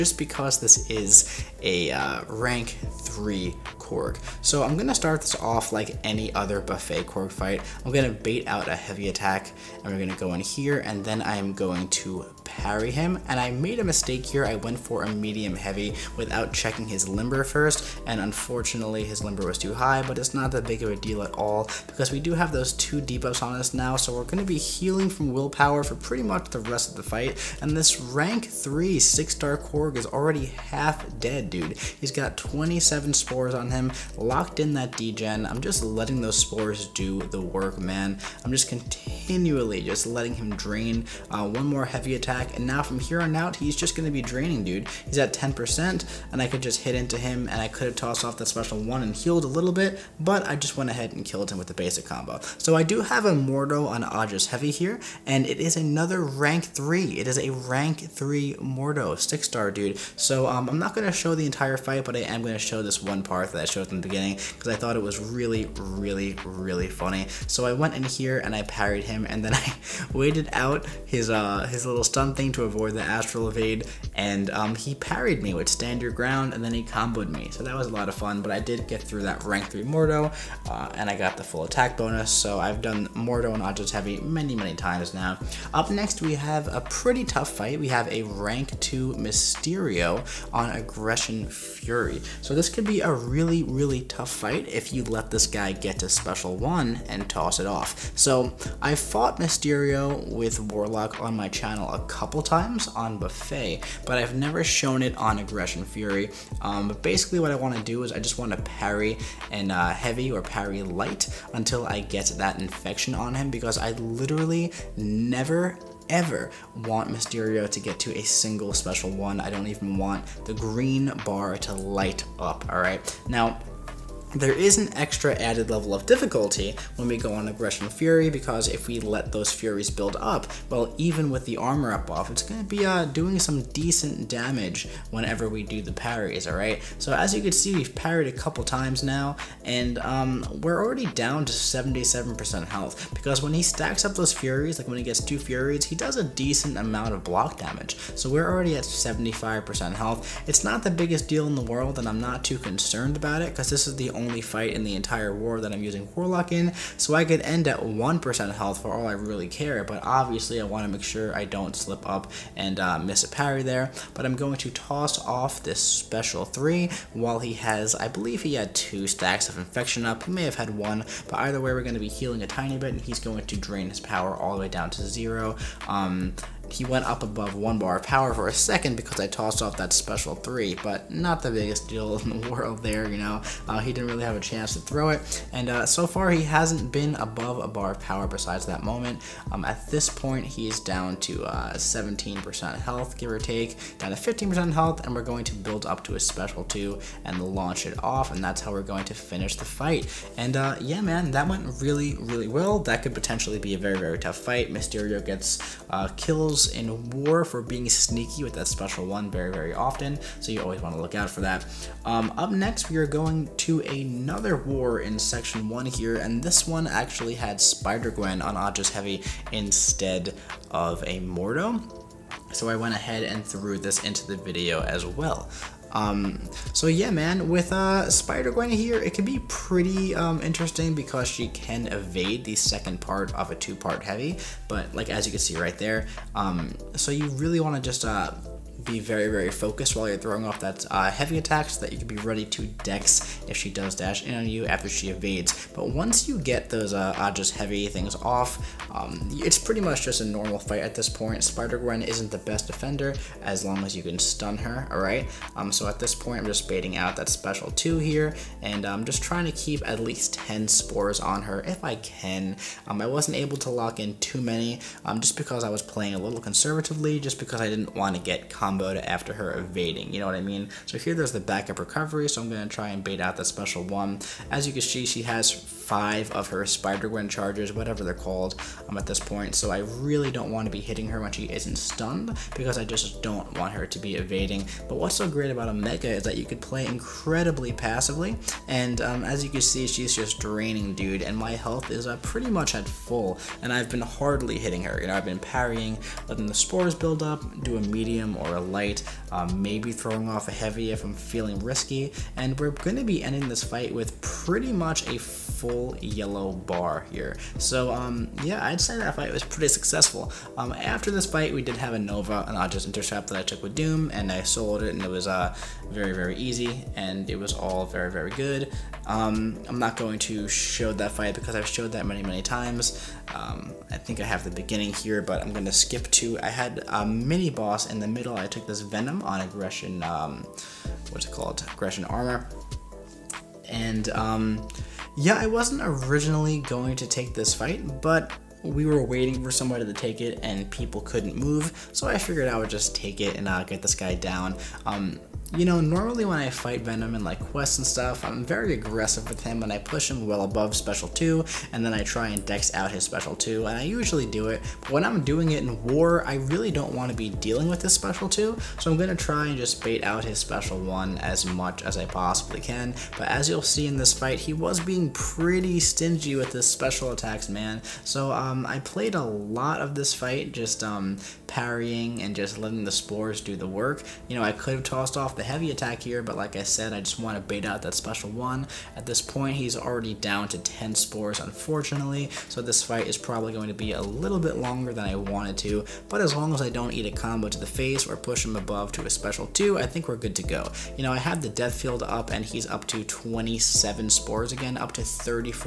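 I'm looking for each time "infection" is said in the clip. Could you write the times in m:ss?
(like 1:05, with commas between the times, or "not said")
1:52, 2:49.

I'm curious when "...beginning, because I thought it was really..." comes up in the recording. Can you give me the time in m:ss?
1:04.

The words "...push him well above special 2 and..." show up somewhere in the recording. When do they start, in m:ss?
5:49.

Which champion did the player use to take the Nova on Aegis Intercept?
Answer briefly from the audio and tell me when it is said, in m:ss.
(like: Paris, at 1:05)
Doom, at 5:13.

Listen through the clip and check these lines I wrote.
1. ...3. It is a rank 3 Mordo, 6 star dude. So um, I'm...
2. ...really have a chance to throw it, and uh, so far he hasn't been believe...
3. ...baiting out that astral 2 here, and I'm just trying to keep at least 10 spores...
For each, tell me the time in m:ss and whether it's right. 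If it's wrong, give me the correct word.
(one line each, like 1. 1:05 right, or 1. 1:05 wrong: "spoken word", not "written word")
1. 0:56 right
2. 3:04 wrong: "above", not "believe"
3. 4:16 wrong: "special", not "astral".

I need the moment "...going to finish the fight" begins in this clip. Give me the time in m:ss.
3:18.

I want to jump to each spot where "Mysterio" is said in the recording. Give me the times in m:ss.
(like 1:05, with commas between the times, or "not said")
1:29, 1:39, 1:57, 3:24.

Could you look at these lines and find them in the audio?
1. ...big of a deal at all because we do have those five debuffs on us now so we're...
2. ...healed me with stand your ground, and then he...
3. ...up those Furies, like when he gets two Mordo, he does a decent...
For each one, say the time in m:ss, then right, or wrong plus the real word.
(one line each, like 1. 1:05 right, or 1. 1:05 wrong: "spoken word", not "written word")
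1. 0:20 wrong: "two", not "five"
2. 1:14 wrong: "parried", not "healed"
3. 2:24 wrong: "Furies", not "Mordo".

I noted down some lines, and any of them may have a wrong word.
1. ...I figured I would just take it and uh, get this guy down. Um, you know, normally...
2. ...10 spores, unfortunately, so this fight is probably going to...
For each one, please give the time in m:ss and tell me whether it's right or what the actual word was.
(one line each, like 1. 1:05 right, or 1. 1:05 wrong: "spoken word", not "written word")
1. 5:42 right
2. 6:20 right.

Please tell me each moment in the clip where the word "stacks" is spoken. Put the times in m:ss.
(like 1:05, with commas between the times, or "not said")
2:23, 2:49.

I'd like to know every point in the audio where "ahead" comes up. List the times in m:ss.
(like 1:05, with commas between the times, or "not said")
0:50, 3:42.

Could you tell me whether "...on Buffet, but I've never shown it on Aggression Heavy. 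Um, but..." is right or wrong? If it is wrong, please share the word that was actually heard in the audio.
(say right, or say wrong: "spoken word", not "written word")
wrong: "Fury", not "Heavy".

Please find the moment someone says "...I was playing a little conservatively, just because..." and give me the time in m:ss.
4:25.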